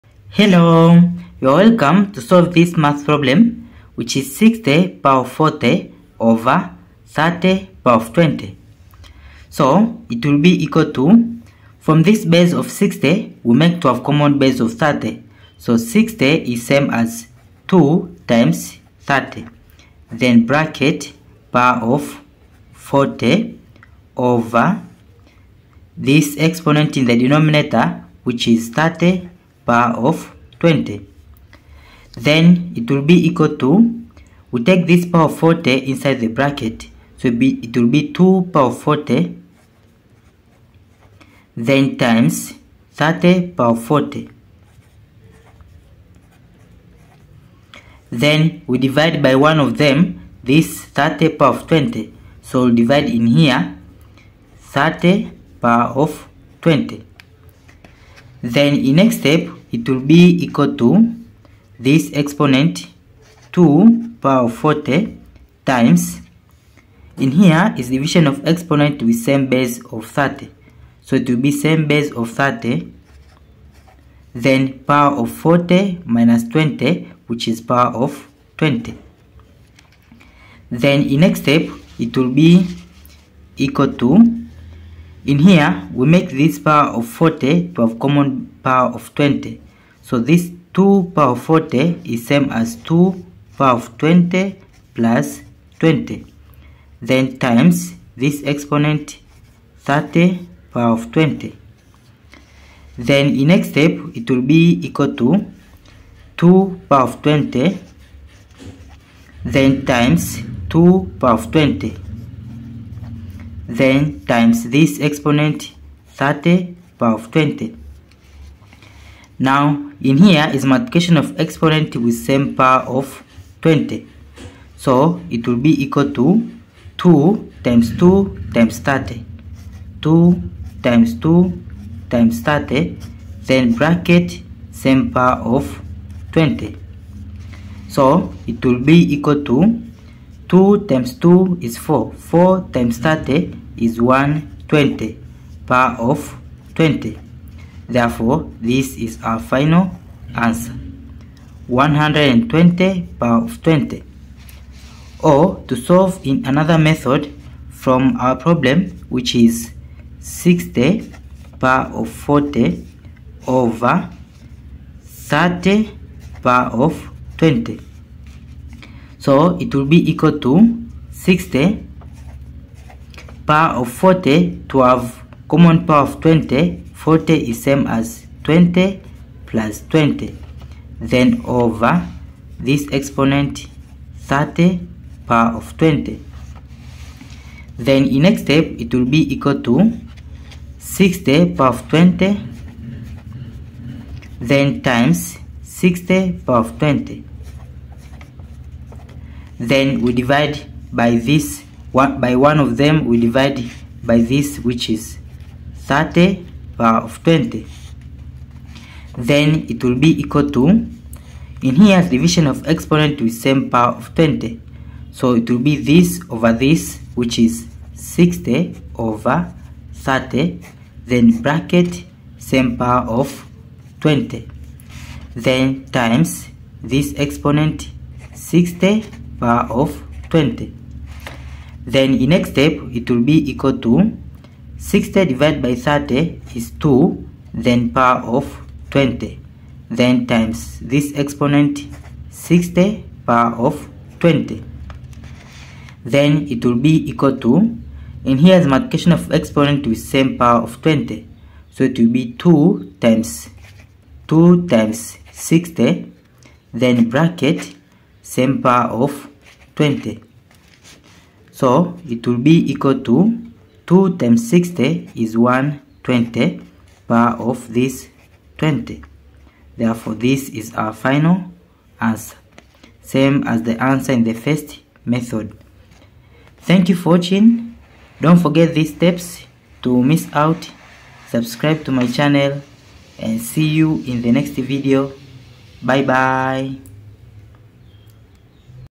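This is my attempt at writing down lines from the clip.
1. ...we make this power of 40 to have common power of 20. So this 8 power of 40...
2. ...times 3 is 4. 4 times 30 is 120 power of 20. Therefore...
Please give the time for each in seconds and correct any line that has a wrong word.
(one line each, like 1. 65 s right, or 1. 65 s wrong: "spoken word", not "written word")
1. 85 s wrong: "2", not "8"
2. 140 s wrong: "2", not "3".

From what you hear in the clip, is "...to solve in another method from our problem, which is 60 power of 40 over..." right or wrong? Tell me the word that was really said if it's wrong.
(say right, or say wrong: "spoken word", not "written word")
right.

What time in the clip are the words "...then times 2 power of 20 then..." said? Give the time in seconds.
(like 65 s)
109 s.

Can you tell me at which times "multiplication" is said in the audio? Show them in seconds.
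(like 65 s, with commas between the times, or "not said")
120 s, 248 s.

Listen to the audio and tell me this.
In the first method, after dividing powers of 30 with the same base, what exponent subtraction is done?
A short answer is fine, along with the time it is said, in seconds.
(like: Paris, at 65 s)
40 minus 20, at 75 s.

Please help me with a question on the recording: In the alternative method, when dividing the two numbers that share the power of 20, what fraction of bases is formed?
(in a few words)
60 over 30.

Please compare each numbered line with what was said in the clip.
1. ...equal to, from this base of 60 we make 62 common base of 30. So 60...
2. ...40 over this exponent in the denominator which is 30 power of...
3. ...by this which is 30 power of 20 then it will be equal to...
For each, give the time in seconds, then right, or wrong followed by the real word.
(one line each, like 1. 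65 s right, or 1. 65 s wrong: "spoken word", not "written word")
1. 10 s wrong: "12", not "62"
2. 22 s right
3. 204 s right.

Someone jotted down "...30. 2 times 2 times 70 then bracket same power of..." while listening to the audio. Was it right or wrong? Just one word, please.
wrong.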